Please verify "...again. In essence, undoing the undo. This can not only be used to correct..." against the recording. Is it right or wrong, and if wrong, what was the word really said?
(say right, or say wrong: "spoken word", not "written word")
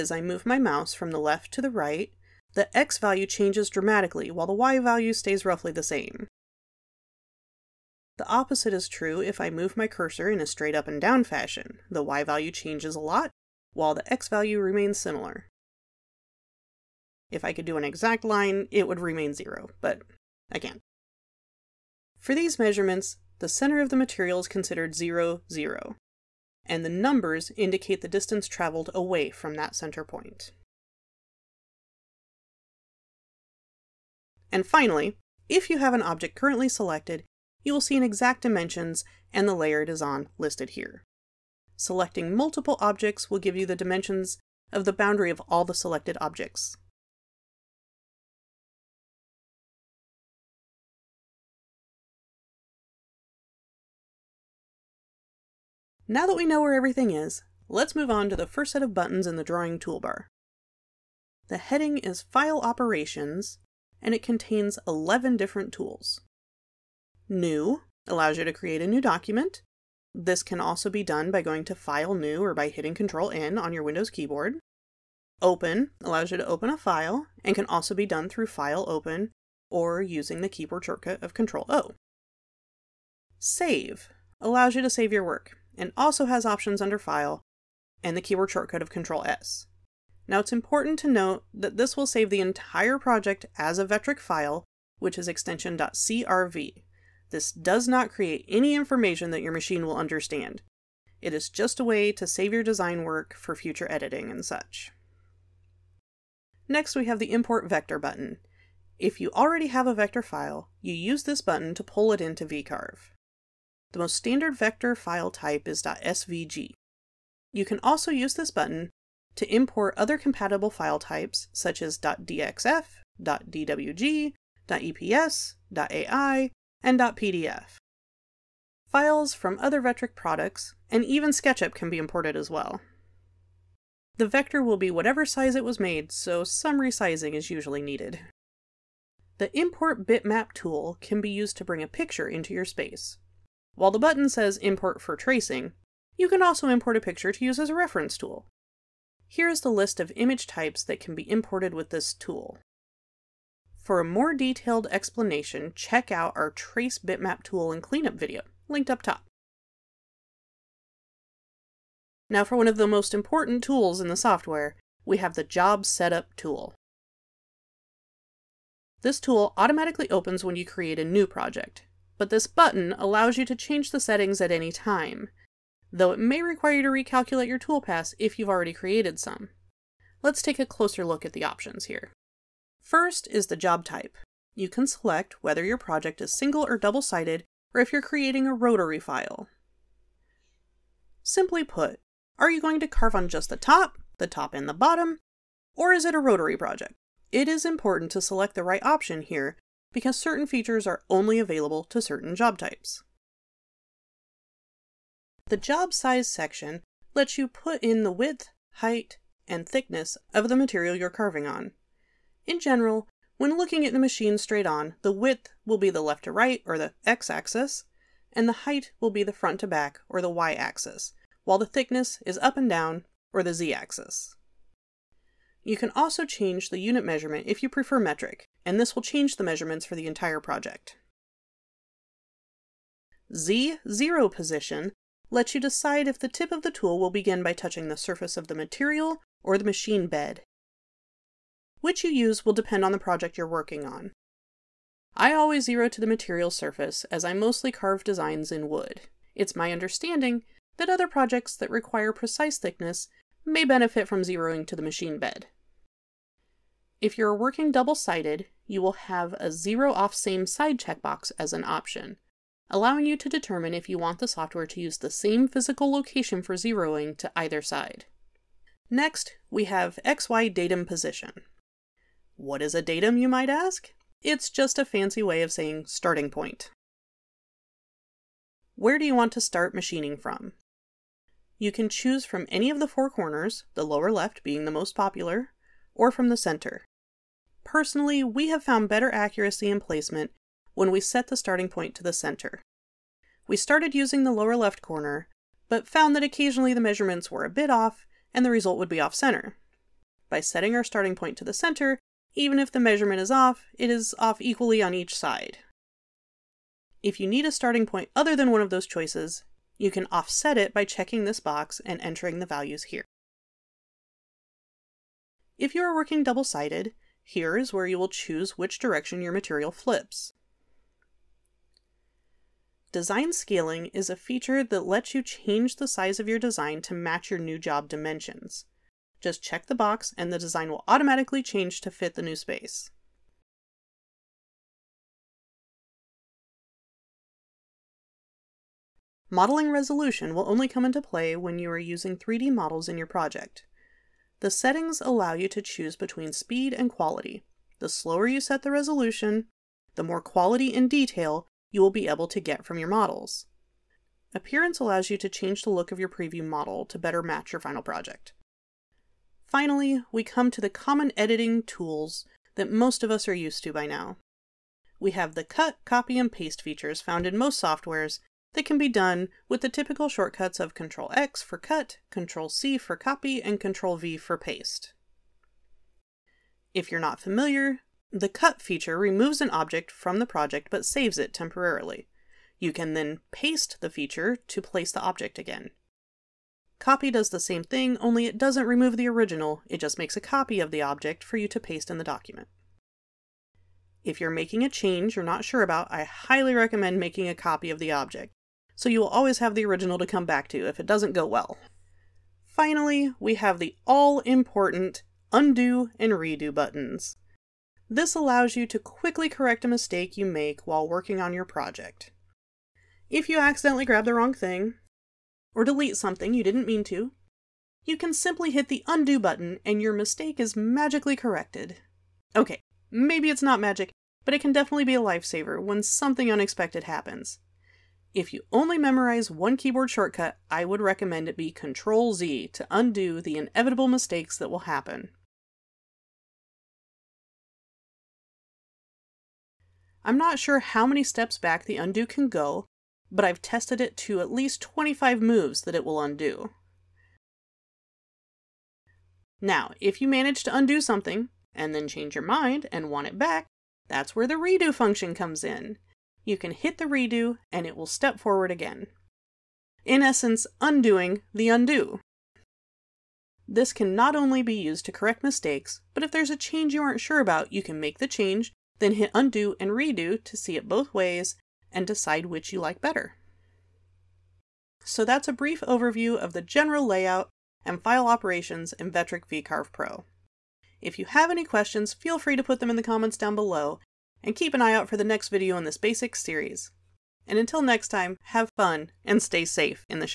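right.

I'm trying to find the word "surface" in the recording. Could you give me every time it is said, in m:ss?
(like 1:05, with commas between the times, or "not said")
3:57, 4:06.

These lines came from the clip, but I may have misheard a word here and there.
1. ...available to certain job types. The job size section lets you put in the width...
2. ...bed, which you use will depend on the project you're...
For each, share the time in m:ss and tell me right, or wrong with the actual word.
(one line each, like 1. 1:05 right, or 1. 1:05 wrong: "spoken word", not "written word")
1. 3:21 right
2. 4:00 right.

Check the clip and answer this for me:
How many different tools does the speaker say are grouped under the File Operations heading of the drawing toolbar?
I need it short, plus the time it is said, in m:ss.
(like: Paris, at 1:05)
11, at 1:04.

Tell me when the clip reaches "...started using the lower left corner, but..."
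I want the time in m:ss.
4:53.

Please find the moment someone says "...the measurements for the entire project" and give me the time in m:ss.
3:49.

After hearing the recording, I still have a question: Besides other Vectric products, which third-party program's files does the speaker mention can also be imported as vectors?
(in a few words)
SketchUp.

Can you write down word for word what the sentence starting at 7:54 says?
So that's a brief overview of the general layout and file operations in Vectric vCarve Pro.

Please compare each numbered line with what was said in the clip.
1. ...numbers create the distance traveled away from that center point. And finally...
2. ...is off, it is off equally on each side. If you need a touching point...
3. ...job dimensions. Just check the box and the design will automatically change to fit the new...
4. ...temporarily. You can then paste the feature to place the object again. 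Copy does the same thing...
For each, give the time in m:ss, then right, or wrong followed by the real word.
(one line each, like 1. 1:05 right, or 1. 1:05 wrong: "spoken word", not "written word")
1. 0:26 wrong: "indicate", not "create"
2. 5:03 wrong: "starting", not "touching"
3. 5:27 right
4. 6:21 right.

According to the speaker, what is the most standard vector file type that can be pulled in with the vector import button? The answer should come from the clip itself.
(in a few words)
.svg.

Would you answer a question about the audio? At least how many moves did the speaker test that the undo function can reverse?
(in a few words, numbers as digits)
25.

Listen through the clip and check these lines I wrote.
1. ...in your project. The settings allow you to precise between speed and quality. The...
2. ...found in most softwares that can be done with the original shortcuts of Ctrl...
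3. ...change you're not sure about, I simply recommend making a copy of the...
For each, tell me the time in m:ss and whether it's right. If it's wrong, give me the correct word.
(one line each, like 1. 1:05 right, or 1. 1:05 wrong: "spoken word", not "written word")
1. 5:42 wrong: "choose", not "precise"
2. 6:07 wrong: "typical", not "original"
3. 6:34 wrong: "highly", not "simply".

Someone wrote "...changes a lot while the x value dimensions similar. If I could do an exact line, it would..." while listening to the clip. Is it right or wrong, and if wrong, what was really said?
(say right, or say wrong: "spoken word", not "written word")
wrong: "remains", not "dimensions".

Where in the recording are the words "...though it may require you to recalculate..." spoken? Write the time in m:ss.
2:55.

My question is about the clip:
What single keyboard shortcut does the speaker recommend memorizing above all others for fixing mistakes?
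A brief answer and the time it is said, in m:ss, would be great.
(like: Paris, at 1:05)
Control Z, at 7:11.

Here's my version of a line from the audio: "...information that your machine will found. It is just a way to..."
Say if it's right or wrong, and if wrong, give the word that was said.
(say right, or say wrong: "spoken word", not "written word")
wrong: "understand", not "found".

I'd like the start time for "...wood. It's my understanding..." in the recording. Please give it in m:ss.
4:08.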